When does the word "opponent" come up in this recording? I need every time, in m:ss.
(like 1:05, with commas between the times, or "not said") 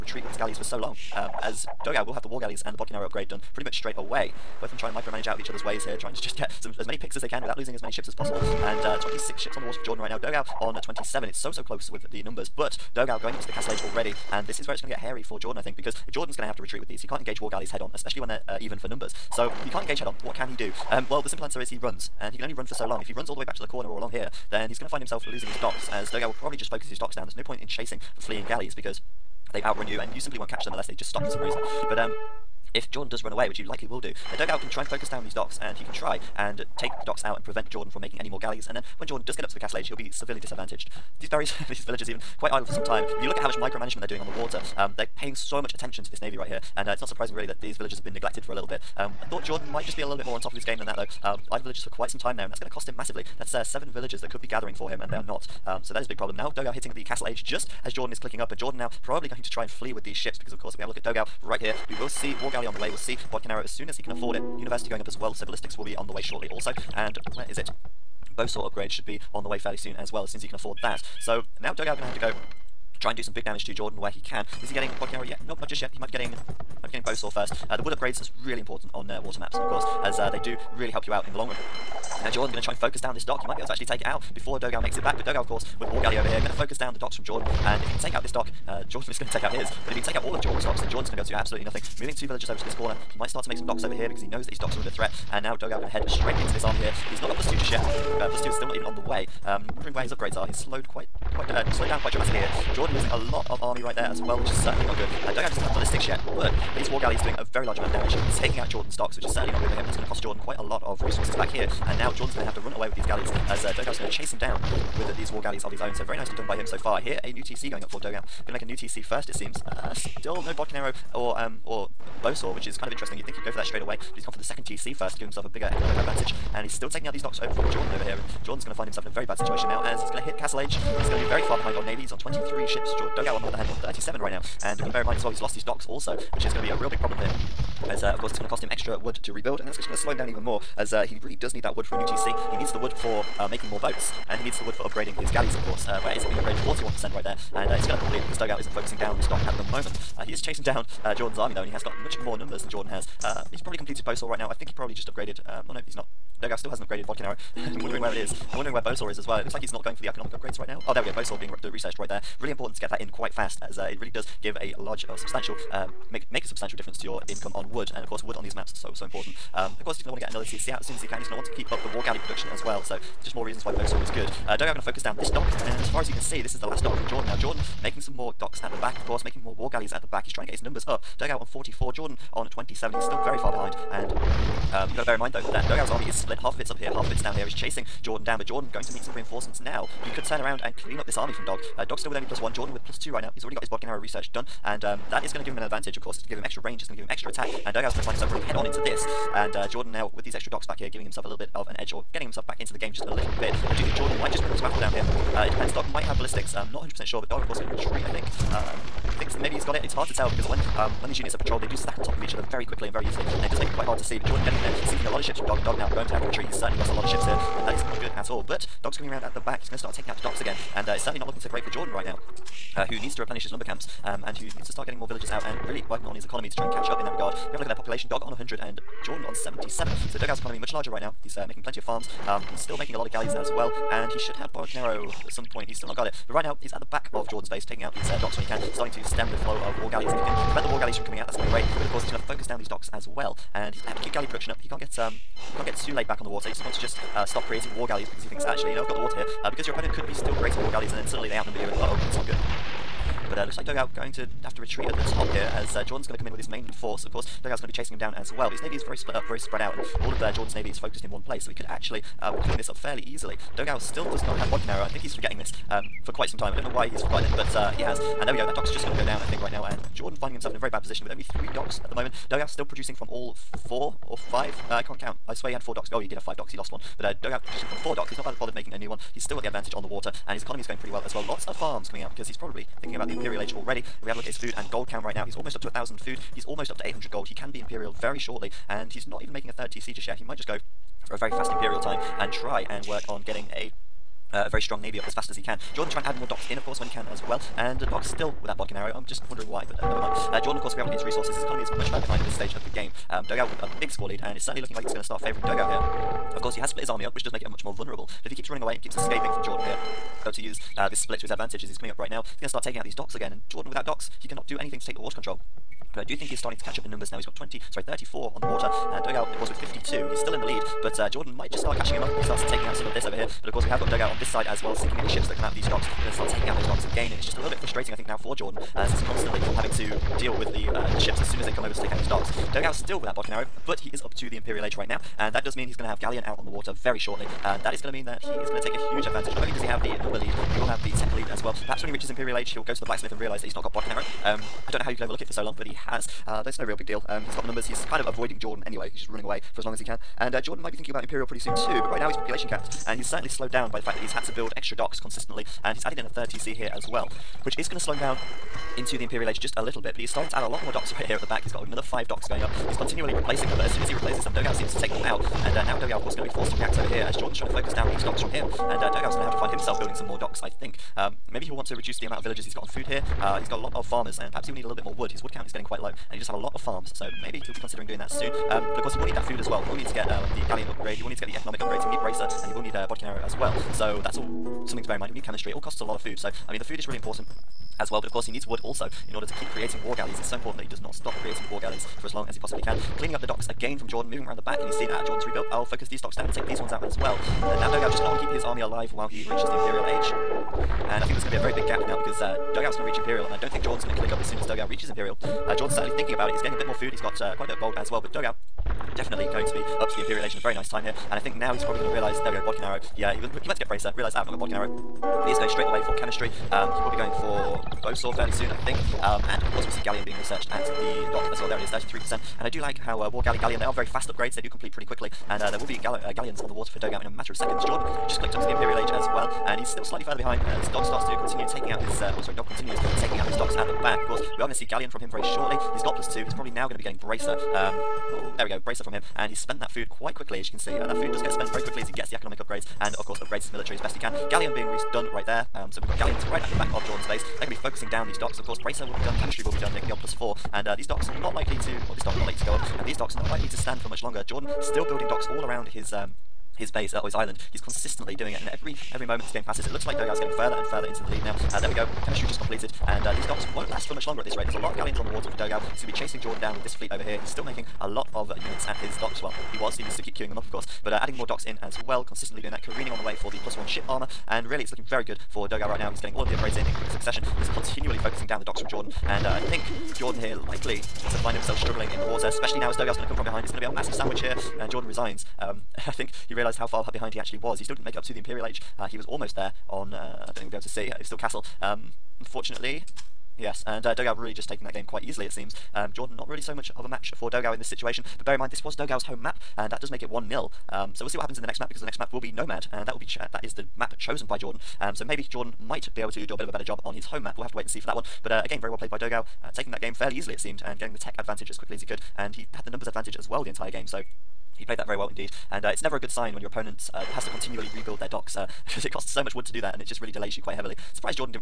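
4:09, 8:36.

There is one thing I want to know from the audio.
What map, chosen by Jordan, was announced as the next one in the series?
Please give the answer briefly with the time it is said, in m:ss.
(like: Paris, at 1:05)
Nomad, at 8:22.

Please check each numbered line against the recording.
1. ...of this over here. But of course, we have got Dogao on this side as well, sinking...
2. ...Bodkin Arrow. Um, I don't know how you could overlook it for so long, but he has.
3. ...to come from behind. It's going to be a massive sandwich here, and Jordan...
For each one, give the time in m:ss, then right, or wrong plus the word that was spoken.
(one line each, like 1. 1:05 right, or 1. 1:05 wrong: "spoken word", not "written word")
1. 5:22 right
2. 5:43 right
3. 8:03 right.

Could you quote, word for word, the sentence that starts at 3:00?
He's trying to get his numbers up.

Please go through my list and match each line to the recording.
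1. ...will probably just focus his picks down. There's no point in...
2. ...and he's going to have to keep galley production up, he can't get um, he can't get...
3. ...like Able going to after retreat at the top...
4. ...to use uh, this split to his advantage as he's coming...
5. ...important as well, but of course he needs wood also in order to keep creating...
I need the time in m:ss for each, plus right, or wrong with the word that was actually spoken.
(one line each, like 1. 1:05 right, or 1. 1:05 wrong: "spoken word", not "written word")
1. 0:26 wrong: "docks", not "picks"
2. 4:03 right
3. 4:13 wrong: "Dogao", not "Able"
4. 5:10 right
5. 6:26 right.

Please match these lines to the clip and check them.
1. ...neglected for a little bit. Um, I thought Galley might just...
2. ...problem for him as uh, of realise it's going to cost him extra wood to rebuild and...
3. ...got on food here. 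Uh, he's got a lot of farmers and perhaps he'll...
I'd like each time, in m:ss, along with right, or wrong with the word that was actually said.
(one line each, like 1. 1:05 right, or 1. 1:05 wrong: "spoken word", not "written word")
1. 0:48 wrong: "Jordan", not "Galley"
2. 2:17 wrong: "course", not "realise"
3. 6:12 right.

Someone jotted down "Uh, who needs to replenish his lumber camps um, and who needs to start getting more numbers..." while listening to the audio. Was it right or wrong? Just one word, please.
wrong.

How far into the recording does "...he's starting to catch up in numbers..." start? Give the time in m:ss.
5:16.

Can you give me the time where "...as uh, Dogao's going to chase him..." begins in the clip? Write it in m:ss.
1:53.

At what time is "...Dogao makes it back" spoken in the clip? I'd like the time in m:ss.
1:24.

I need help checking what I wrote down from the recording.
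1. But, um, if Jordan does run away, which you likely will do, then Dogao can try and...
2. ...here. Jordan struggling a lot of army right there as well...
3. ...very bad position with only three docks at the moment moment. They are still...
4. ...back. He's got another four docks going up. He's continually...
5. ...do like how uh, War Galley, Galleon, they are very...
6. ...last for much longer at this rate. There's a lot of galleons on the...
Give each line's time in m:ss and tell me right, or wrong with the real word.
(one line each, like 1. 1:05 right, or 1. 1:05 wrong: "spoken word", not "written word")
1. 0:31 right
2. 1:42 wrong: "losing", not "struggling"
3. 4:30 right
4. 6:01 wrong: "five", not "four"
5. 7:02 right
6. 7:43 right.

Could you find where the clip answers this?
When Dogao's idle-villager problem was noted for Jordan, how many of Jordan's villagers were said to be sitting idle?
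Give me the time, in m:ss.
0:53.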